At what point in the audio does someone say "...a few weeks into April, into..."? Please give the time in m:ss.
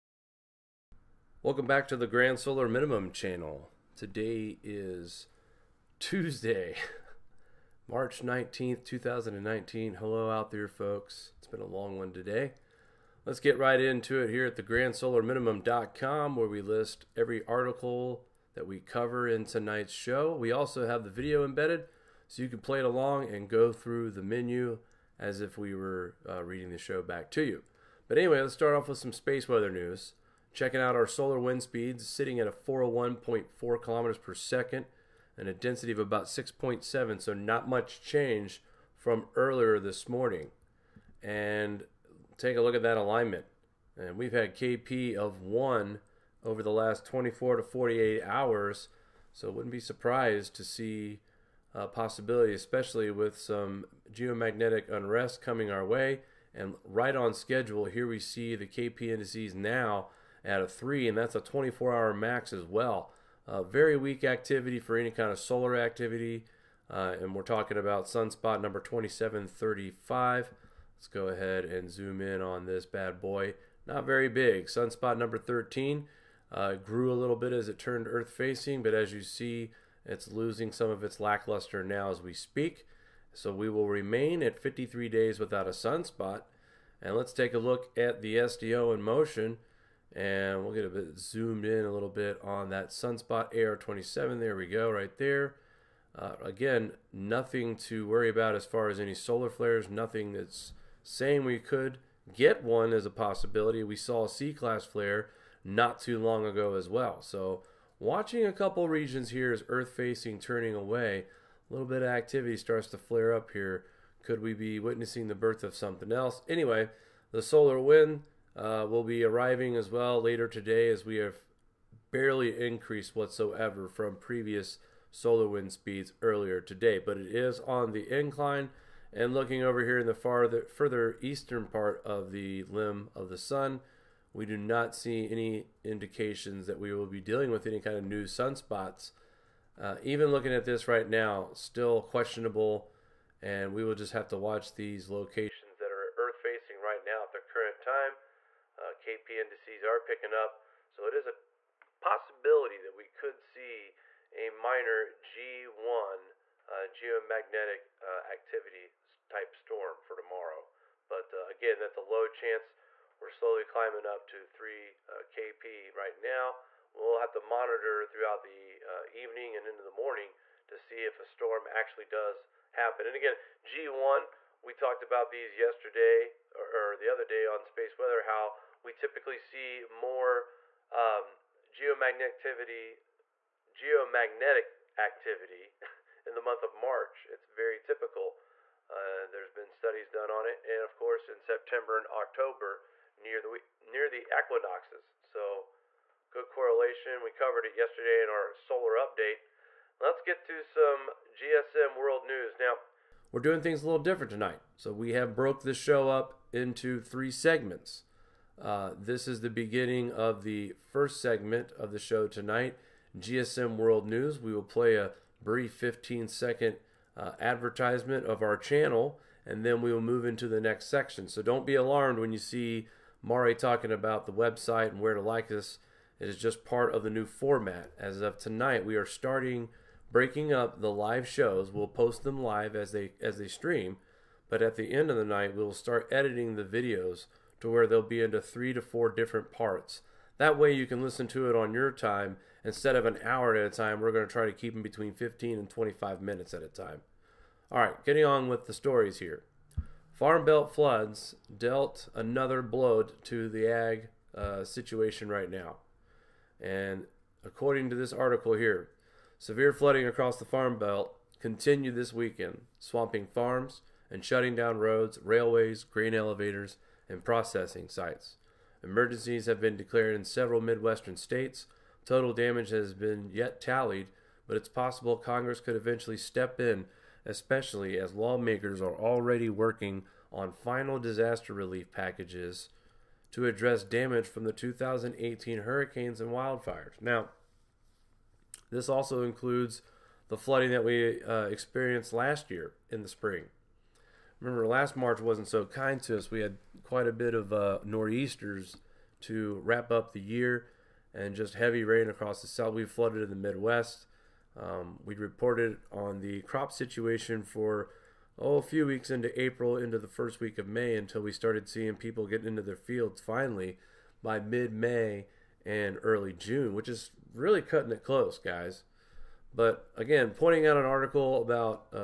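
5:08.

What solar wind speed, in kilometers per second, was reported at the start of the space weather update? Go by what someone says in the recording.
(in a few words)
401.4.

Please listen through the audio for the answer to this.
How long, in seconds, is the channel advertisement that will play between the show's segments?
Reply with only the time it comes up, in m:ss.
3:35.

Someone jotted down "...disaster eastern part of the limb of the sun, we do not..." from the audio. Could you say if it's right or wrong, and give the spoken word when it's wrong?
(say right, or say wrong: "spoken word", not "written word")
wrong: "further", not "disaster".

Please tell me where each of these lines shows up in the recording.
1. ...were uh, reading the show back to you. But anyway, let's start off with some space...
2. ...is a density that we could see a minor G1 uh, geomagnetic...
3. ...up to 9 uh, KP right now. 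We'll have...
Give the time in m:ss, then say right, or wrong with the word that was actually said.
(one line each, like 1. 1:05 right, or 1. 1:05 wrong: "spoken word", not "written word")
1. 0:25 right
2. 2:31 wrong: "possibility", not "density"
3. 2:44 wrong: "3", not "9".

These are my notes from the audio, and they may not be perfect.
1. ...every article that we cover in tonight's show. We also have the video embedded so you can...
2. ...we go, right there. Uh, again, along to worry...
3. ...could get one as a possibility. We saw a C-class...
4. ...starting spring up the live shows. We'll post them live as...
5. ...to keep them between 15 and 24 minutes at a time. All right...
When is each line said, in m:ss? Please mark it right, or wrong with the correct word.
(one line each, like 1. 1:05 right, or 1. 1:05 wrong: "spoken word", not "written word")
1. 0:17 right
2. 1:34 wrong: "nothing", not "along"
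3. 1:41 right
4. 3:49 wrong: "breaking", not "spring"
5. 4:04 wrong: "25", not "24".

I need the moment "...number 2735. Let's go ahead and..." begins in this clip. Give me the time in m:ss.
1:08.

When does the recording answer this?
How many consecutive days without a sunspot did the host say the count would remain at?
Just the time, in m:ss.
1:24.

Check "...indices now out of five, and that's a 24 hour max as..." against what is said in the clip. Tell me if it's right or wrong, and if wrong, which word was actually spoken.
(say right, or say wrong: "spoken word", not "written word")
wrong: "three", not "five".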